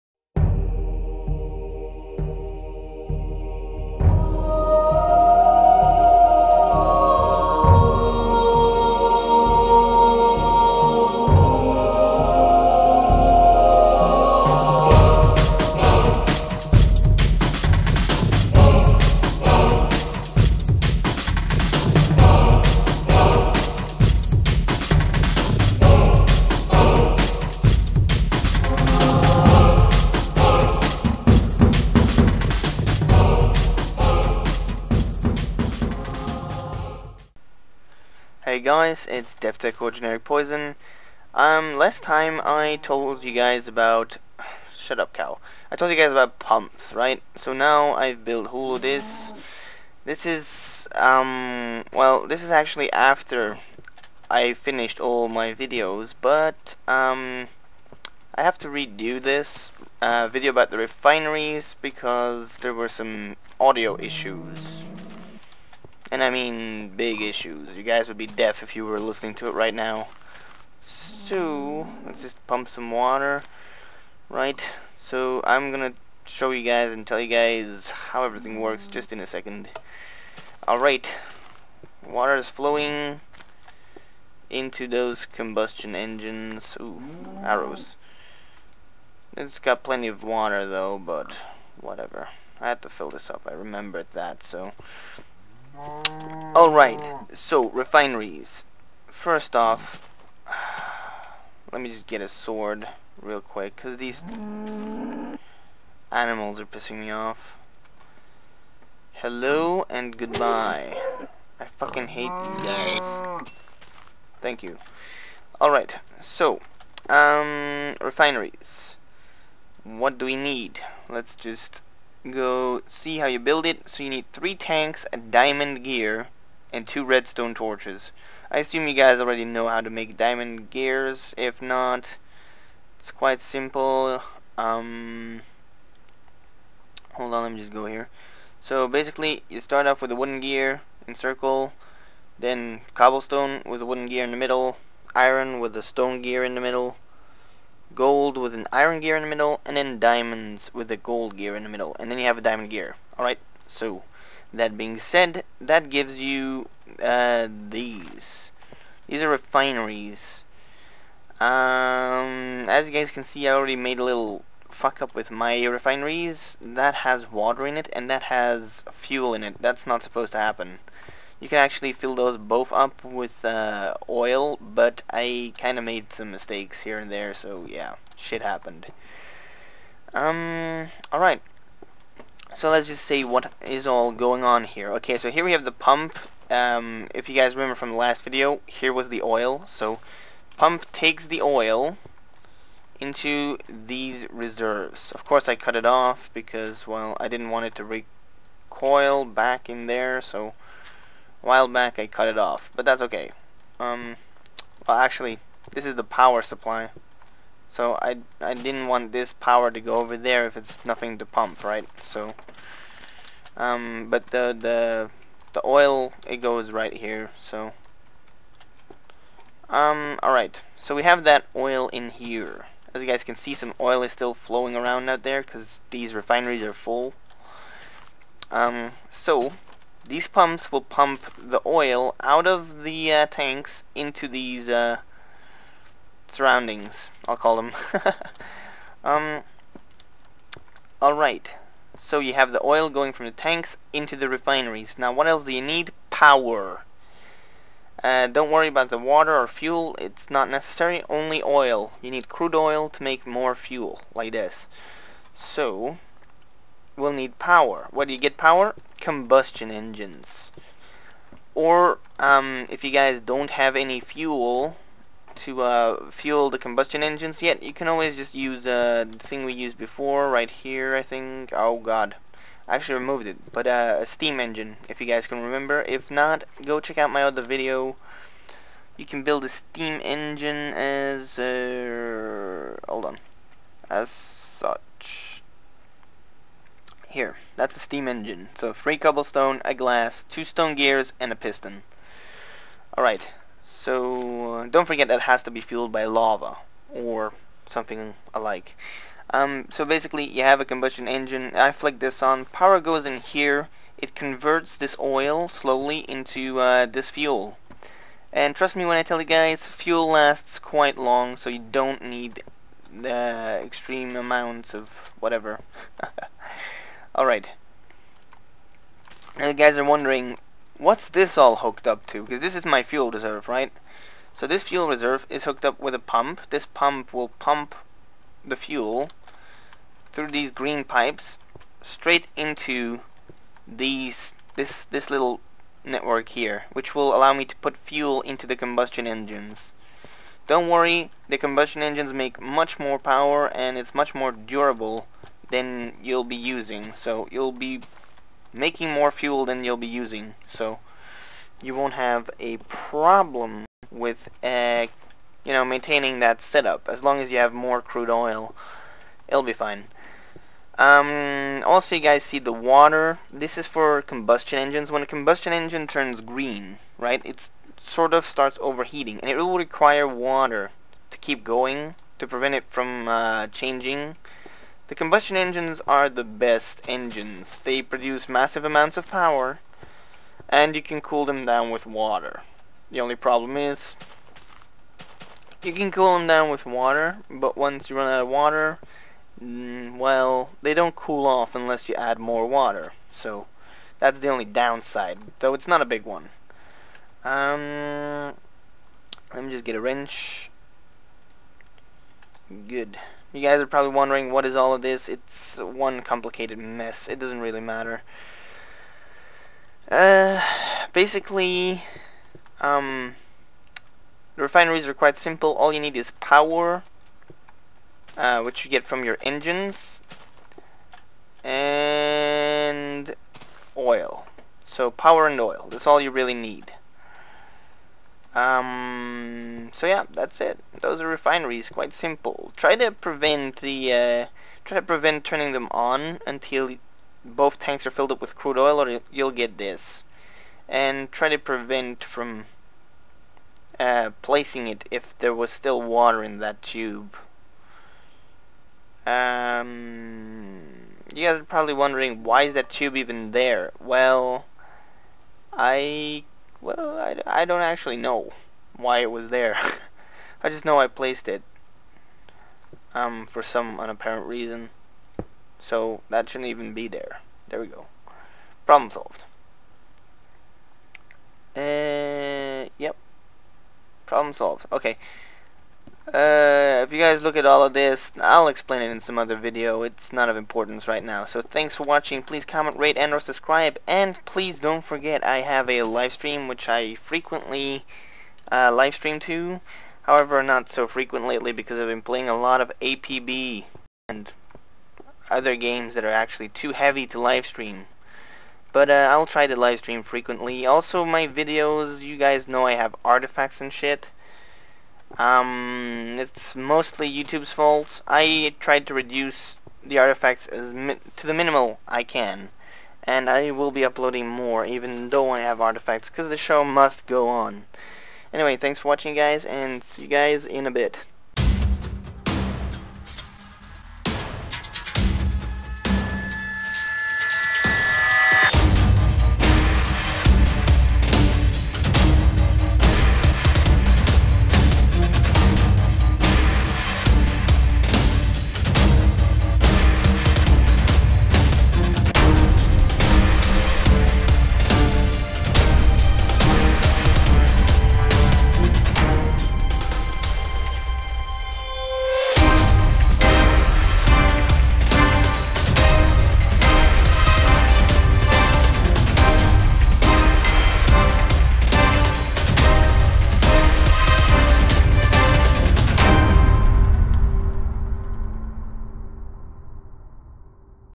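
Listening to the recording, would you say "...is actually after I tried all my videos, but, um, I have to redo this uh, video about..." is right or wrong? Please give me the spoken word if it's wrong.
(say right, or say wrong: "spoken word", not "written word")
wrong: "finished", not "tried".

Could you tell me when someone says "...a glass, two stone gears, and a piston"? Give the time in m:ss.
4:49.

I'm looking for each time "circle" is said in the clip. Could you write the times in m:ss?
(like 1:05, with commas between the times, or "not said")
2:21.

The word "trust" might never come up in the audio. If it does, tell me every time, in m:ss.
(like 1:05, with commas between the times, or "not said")
5:08.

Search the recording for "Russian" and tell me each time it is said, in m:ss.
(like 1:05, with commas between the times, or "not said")
not said.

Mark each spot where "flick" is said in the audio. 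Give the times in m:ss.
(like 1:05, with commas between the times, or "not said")
5:01.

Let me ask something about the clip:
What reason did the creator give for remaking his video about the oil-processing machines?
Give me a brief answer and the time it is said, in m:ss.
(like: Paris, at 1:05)
Audio issues, at 1:03.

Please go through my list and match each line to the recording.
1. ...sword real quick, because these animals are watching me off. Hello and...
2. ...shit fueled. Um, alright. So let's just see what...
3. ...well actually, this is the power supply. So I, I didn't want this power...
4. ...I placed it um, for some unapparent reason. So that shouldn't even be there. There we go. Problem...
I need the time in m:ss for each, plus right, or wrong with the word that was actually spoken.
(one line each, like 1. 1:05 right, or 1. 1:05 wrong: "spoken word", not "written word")
1. 1:42 wrong: "pissing", not "watching"
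2. 2:58 wrong: "happened", not "fueled"
3. 3:24 right
4. 7:40 right.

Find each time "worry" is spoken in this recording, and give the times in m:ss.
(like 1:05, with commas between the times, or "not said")
4:08, 5:40.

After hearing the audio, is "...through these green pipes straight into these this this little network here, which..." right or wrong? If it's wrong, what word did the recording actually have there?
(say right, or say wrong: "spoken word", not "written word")
right.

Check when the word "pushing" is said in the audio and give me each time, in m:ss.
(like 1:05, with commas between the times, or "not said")
not said.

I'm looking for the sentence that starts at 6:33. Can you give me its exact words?
So that's the only downside, though it's not a big one.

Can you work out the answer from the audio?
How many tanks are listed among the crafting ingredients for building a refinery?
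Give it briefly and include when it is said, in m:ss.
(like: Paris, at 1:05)
3, at 2:04.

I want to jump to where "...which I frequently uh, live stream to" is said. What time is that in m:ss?
8:06.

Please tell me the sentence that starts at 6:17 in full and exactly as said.
They produce massive amounts of power and you can cool them down with water.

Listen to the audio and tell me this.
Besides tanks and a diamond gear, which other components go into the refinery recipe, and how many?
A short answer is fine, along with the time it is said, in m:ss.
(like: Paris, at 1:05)
2 redstone torches, at 2:06.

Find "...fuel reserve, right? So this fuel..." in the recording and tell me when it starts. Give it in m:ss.
5:22.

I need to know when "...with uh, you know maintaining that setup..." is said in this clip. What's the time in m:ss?
5:53.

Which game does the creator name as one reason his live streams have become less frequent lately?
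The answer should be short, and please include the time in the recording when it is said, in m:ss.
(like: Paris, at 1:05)
APB, at 8:12.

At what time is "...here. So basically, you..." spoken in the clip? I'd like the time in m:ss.
2:17.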